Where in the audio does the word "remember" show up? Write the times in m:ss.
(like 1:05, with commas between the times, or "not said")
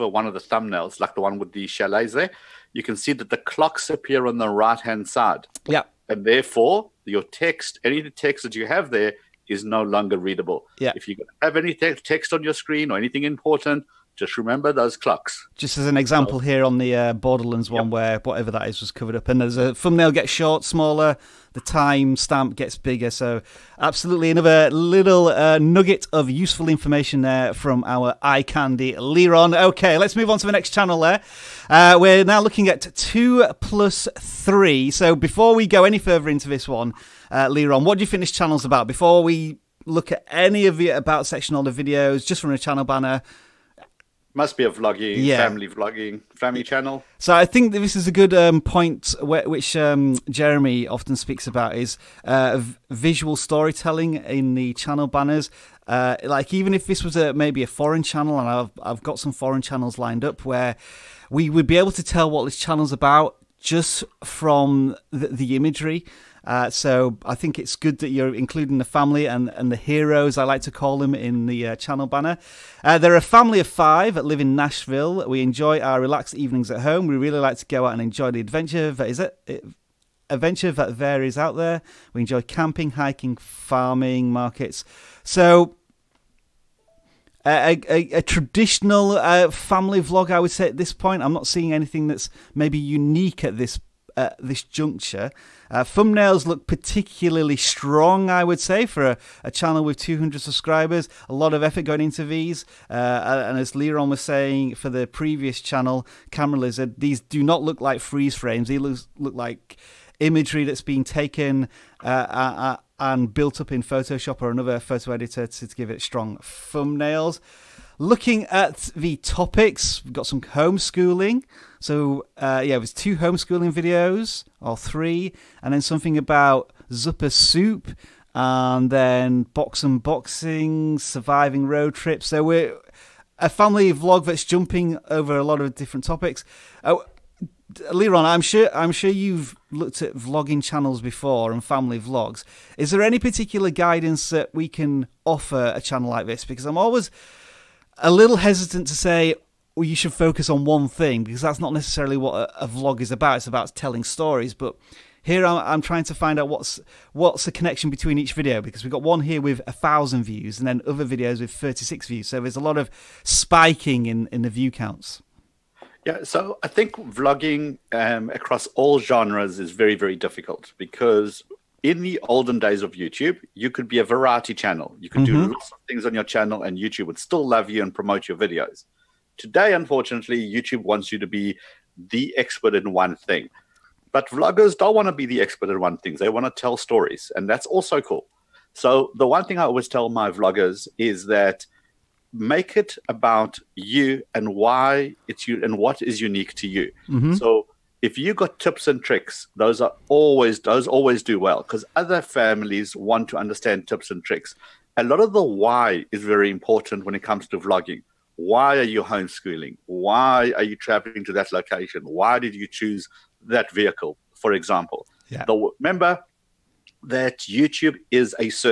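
0:14, 3:35.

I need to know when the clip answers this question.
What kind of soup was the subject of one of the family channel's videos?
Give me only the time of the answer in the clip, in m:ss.
2:06.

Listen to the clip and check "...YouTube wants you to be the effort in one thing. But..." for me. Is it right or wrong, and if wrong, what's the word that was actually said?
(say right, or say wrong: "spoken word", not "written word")
wrong: "expert", not "effort".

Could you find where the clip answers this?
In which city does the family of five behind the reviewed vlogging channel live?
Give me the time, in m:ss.
1:14.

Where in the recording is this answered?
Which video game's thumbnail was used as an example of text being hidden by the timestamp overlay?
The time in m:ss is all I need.
0:17.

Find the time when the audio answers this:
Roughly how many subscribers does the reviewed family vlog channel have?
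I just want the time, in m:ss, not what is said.
1:39.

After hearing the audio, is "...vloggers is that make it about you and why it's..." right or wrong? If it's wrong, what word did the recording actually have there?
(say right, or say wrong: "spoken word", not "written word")
right.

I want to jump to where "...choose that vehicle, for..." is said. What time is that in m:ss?
3:32.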